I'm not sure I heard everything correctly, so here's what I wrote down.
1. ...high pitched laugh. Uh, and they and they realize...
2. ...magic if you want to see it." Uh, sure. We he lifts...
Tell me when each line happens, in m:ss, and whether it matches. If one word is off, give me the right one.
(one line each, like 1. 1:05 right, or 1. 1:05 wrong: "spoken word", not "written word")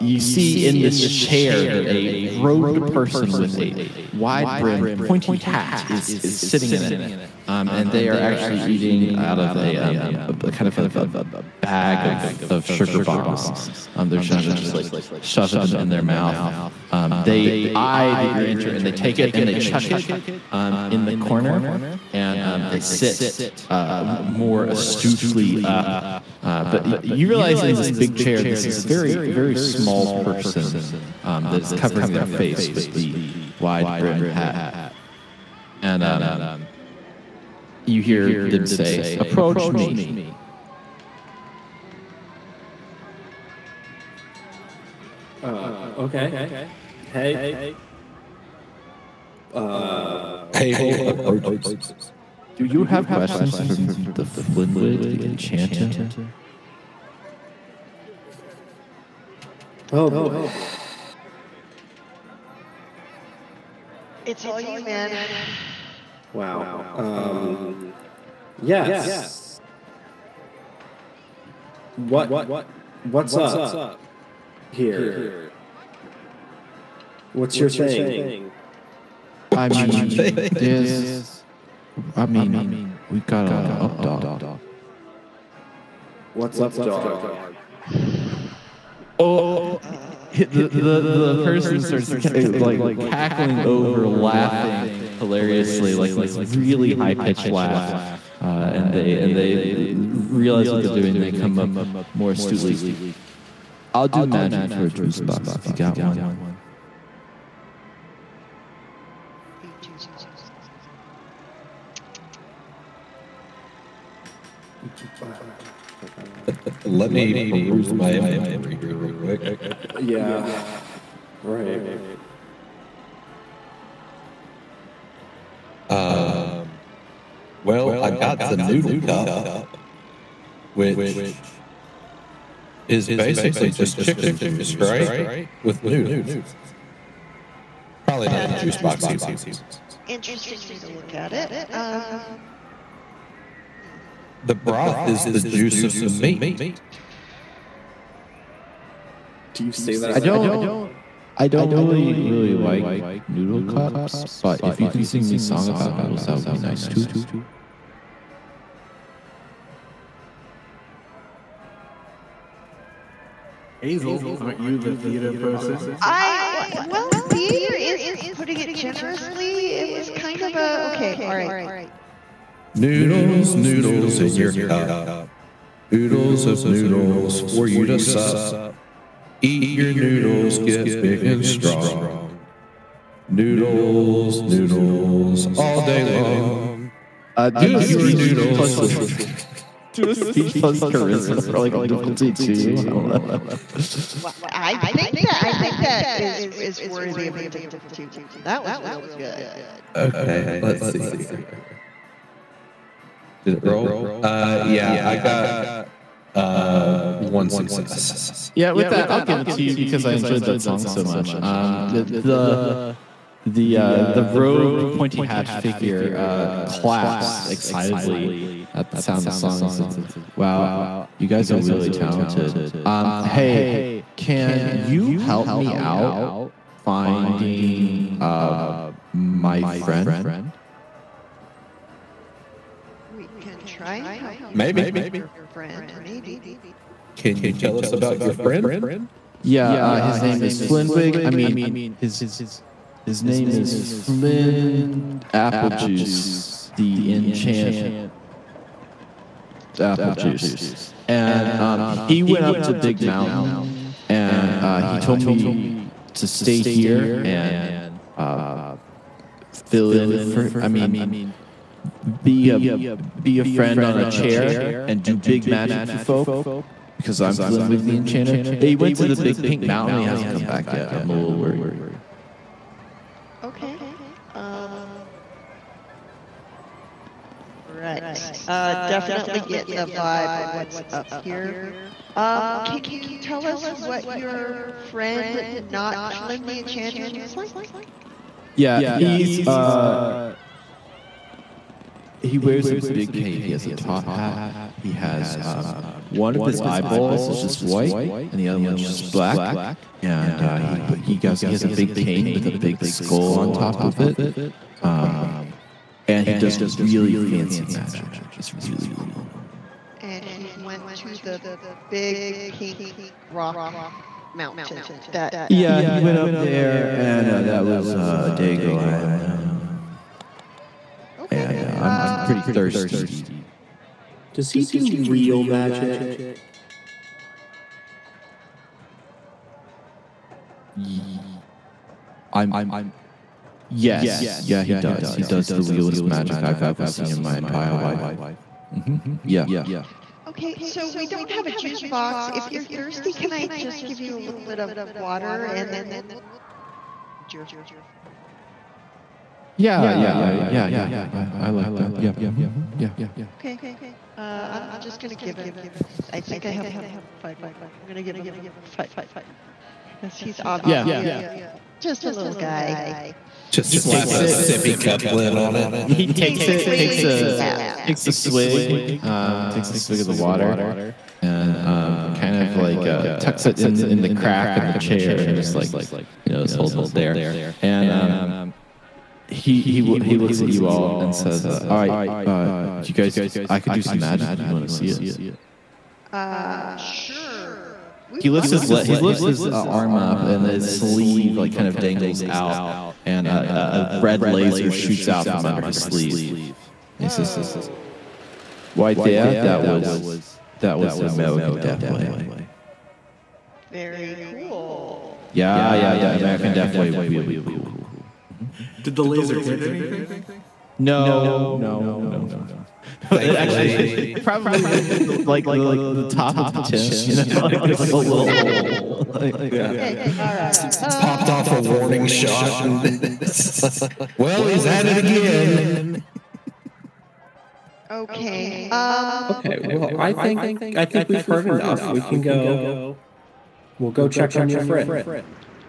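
1. 1:36 right
2. 6:23 right.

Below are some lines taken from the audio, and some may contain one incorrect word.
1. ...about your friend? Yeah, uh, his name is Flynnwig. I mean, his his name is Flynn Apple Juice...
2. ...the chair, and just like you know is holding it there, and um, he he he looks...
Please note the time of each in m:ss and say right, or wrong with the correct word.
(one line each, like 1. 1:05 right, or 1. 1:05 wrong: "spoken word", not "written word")
1. 3:57 right
2. 6:14 right.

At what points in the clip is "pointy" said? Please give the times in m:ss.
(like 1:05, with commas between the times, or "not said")
0:04, 3:34.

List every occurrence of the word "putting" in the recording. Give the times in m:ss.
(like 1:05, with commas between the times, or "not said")
2:48.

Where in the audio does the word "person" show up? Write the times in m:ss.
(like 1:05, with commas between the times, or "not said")
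0:02, 0:30, 1:31, 2:45.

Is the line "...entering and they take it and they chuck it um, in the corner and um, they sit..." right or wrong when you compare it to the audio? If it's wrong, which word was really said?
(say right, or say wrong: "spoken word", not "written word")
right.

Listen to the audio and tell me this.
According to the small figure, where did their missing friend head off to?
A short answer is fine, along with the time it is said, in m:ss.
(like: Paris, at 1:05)
The big pink mountain, at 4:29.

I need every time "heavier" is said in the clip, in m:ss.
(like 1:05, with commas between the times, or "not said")
not said.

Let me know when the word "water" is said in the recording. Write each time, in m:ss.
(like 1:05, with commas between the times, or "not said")
5:44, 6:10.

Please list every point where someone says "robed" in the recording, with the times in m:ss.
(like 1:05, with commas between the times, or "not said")
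0:02, 3:34.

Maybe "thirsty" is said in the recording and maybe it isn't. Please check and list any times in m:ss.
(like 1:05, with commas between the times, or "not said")
5:22, 5:42.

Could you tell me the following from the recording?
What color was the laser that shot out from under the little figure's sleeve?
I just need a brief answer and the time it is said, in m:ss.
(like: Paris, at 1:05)
Red, at 6:33.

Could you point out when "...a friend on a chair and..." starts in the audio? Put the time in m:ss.
4:23.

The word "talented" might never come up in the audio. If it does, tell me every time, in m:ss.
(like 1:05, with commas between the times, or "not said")
3:41.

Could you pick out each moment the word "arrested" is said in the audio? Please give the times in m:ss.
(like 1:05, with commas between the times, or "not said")
not said.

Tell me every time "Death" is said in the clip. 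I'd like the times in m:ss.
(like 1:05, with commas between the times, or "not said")
6:41, 6:46.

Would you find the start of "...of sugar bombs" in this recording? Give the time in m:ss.
0:12.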